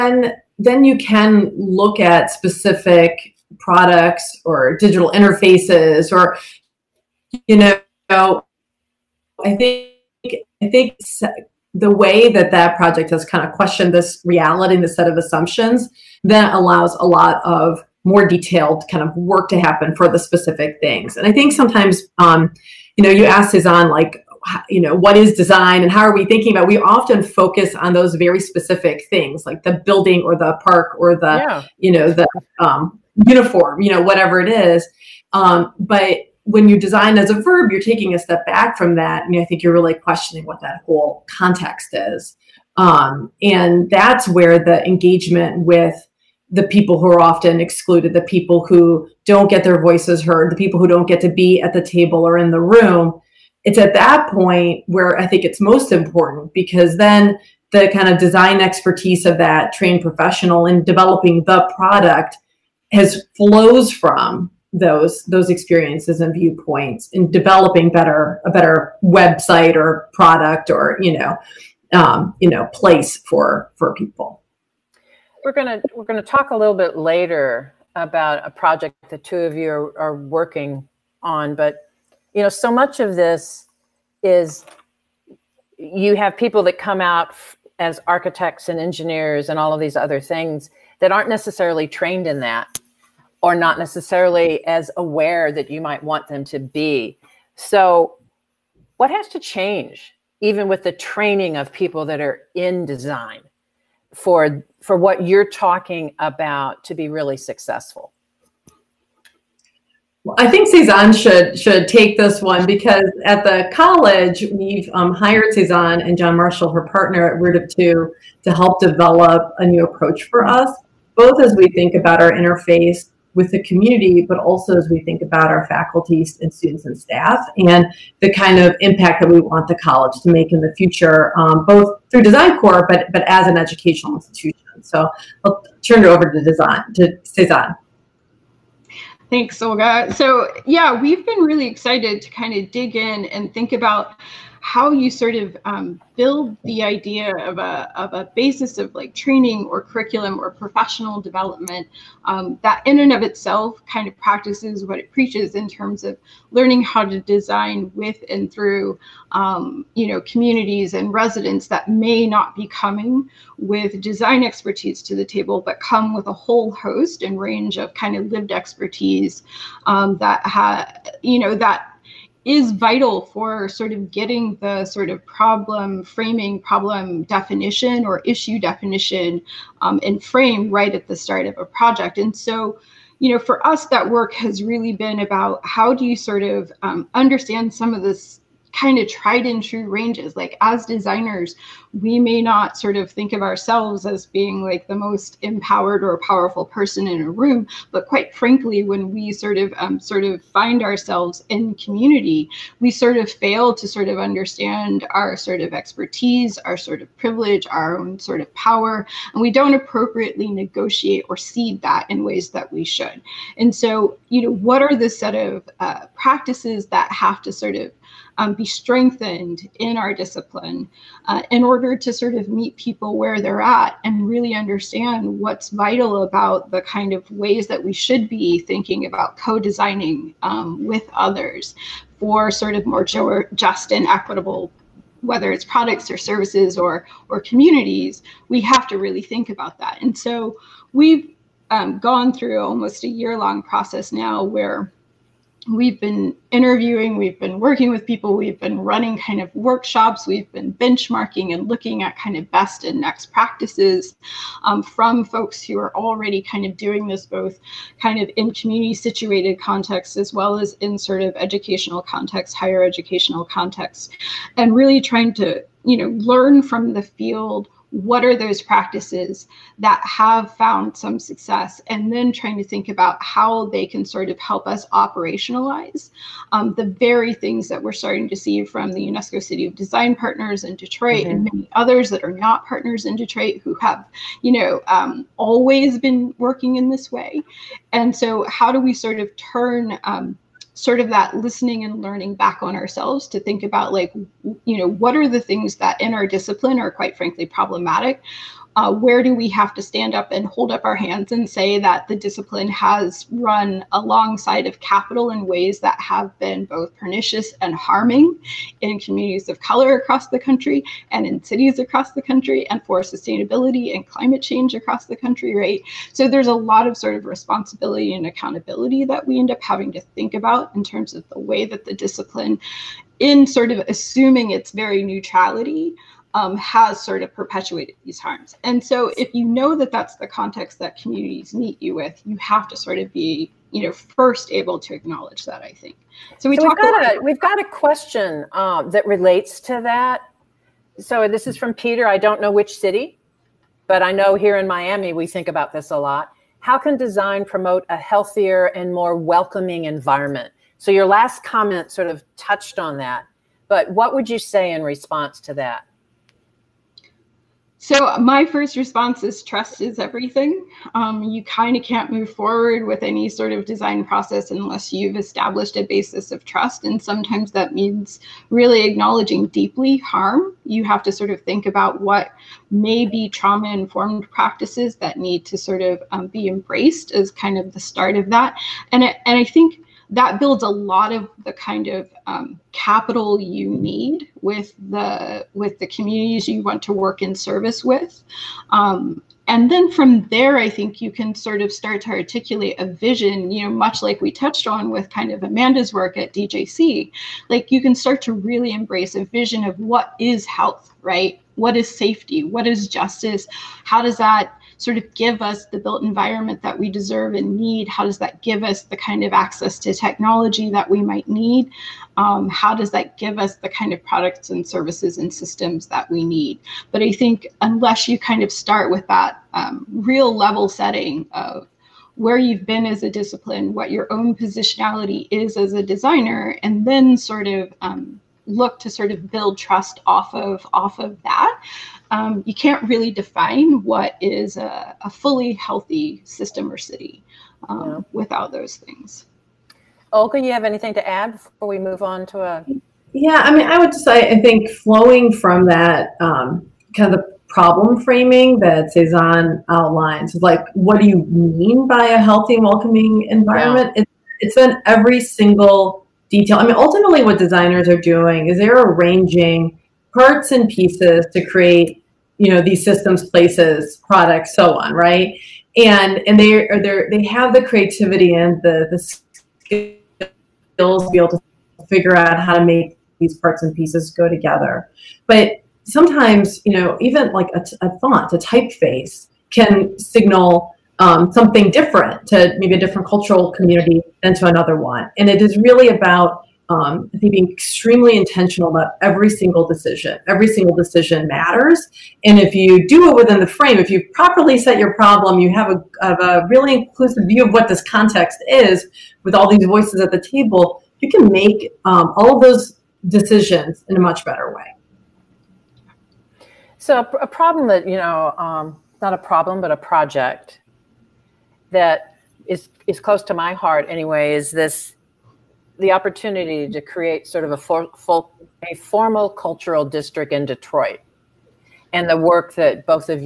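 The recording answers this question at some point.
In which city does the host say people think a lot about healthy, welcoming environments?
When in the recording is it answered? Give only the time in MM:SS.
05:44.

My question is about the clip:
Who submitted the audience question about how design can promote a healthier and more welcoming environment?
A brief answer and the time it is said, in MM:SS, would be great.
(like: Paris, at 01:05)
Peter, at 05:41.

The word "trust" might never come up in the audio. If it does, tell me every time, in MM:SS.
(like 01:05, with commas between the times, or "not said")
05:59, 06:06, 07:09.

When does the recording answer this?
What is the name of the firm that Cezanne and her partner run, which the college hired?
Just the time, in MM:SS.
01:57.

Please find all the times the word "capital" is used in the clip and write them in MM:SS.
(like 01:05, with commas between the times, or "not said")
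05:04, 06:22.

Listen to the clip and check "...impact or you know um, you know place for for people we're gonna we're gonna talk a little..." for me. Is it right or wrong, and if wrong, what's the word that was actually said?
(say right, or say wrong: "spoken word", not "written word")
wrong: "product", not "impact".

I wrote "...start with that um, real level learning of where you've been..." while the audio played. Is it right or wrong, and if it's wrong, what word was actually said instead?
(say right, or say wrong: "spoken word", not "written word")
wrong: "setting", not "learning".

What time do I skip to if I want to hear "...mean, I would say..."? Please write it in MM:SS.
07:23.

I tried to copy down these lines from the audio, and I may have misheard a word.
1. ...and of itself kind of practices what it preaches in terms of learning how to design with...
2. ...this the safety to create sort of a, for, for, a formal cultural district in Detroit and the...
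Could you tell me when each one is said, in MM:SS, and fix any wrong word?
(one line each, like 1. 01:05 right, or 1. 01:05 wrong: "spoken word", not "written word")
1. 02:32 right
2. 08:34 wrong: "opportunity", not "safety".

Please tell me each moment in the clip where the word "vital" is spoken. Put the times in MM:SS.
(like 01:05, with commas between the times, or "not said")
02:52, 03:45.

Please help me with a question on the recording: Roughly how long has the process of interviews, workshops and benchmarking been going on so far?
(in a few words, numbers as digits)
almost a year.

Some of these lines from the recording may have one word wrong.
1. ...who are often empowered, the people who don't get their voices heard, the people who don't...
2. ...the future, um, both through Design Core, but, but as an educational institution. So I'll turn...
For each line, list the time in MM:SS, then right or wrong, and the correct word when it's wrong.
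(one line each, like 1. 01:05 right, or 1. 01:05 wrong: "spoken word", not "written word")
1. 00:46 wrong: "excluded", not "empowered"
2. 02:10 right.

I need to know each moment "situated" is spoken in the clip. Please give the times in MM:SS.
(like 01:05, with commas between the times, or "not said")
04:18.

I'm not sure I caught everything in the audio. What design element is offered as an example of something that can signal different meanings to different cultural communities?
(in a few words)
a typeface.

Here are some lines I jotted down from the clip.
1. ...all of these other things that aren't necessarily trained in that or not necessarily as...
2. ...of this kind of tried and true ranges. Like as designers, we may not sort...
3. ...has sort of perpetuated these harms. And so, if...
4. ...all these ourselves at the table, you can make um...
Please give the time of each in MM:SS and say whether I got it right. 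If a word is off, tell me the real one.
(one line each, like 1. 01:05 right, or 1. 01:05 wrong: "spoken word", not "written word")
1. 01:29 right
2. 03:07 right
3. 05:26 right
4. 08:19 wrong: "voices", not "ourselves".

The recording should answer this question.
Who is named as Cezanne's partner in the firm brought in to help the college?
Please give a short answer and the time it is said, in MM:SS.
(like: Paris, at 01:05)
John Marshall, at 01:56.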